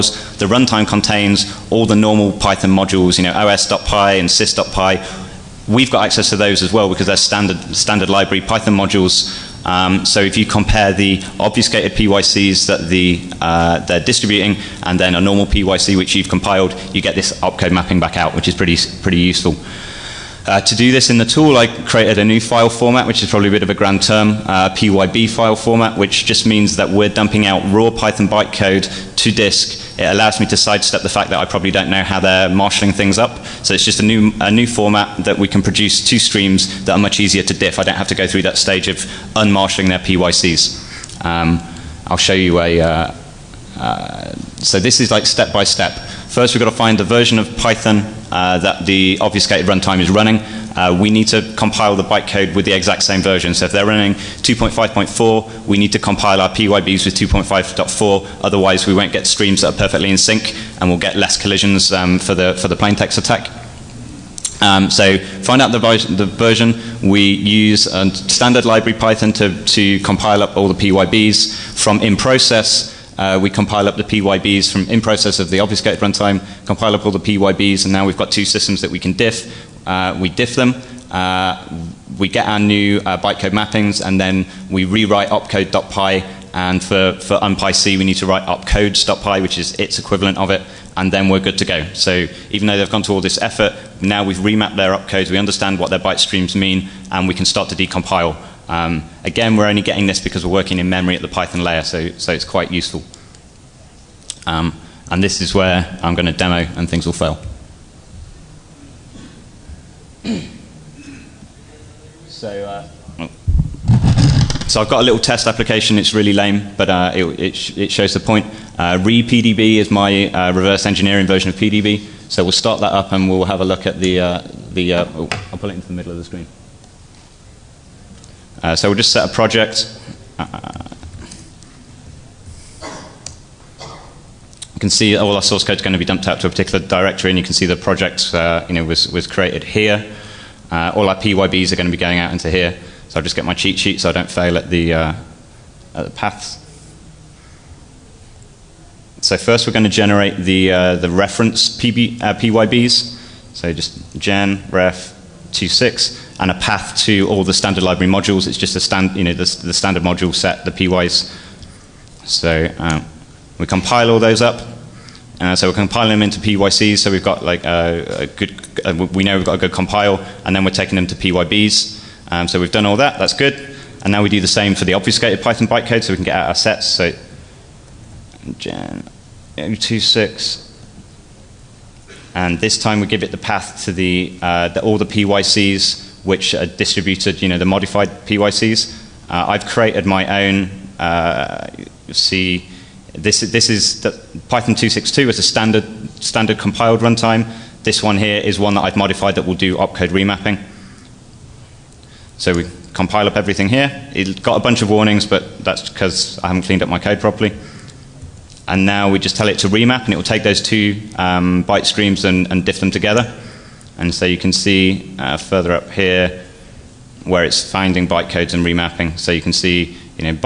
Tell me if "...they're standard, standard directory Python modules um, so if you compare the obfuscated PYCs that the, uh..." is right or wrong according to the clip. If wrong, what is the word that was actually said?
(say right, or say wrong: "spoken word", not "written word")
wrong: "library", not "directory".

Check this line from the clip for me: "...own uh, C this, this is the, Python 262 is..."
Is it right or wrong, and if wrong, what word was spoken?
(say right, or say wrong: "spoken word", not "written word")
right.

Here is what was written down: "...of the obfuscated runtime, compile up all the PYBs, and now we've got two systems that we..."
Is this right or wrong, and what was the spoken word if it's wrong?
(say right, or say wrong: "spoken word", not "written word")
right.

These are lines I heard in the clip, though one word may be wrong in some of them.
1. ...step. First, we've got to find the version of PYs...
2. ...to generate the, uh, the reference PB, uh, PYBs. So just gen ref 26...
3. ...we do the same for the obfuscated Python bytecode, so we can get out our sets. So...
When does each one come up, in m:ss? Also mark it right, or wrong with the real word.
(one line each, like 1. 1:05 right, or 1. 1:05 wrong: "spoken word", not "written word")
1. 0:45 wrong: "Python", not "PYs"
2. 2:29 right
3. 2:54 right.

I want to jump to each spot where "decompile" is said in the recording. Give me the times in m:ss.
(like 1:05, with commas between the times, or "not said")
1:37.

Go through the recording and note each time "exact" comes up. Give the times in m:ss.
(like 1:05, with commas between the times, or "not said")
0:52.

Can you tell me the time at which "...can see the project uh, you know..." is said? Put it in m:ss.
2:17.